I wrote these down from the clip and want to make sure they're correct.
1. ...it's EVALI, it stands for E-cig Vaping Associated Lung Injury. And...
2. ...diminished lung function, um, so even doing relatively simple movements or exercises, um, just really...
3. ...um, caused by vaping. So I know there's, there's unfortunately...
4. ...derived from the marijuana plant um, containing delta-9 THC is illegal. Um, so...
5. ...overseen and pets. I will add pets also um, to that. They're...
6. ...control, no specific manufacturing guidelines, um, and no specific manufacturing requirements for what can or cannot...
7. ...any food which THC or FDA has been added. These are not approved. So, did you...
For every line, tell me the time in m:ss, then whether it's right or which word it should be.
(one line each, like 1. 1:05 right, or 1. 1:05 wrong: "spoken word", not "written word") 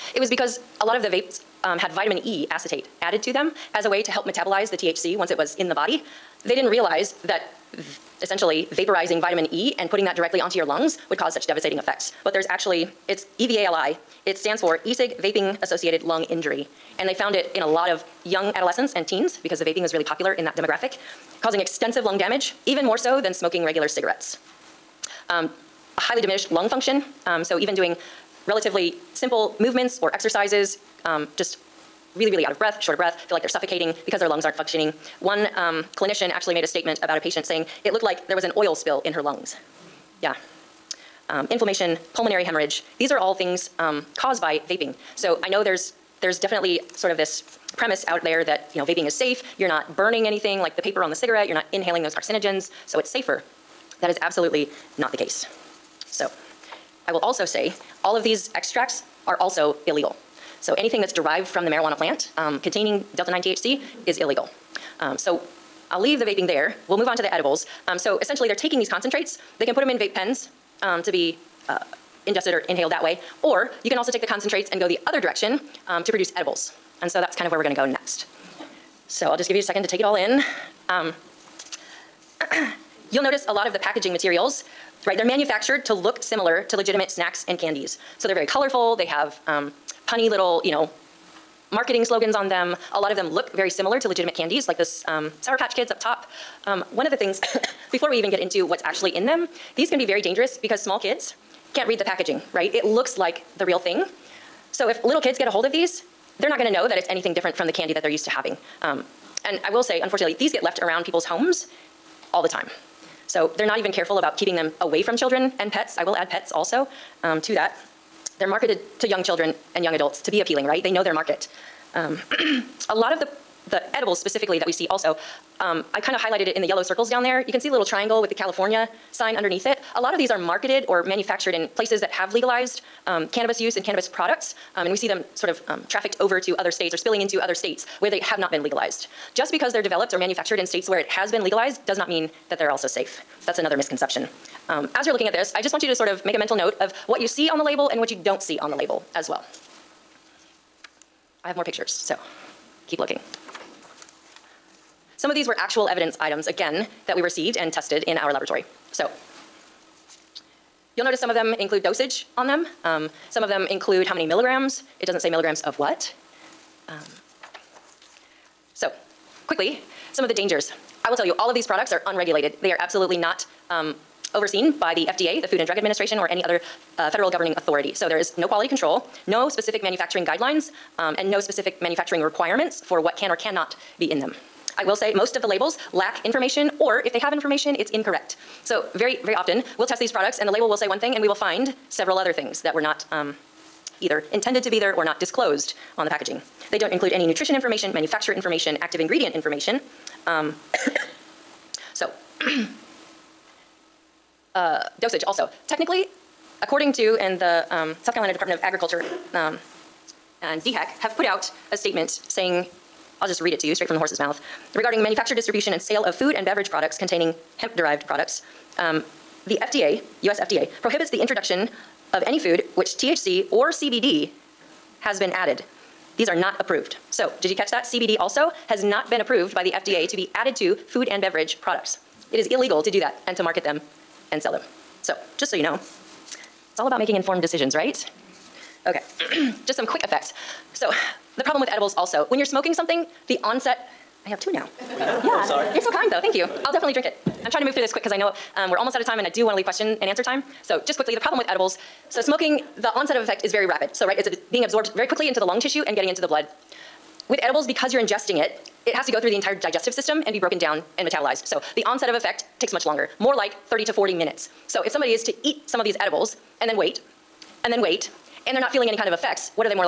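1. 0:13 right
2. 0:26 right
3. 0:43 wrong: "definitely", not "unfortunately"
4. 1:01 right
5. 1:55 wrong: "children", not "overseen"
6. 2:58 right
7. 3:42 wrong: "CBD", not "FDA".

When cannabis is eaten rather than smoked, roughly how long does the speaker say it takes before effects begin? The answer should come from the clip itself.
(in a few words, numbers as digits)
30 to 40 minutes.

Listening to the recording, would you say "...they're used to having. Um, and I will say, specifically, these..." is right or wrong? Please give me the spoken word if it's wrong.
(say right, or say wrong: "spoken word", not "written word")
wrong: "unfortunately", not "specifically".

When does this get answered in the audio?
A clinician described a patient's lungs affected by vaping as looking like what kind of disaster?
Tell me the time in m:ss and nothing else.
0:38.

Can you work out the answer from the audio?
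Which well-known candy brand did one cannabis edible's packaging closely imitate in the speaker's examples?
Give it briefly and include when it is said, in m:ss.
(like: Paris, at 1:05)
Sour Patch Kids, at 1:35.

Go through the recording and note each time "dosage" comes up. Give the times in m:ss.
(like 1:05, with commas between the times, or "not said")
2:41, 3:25.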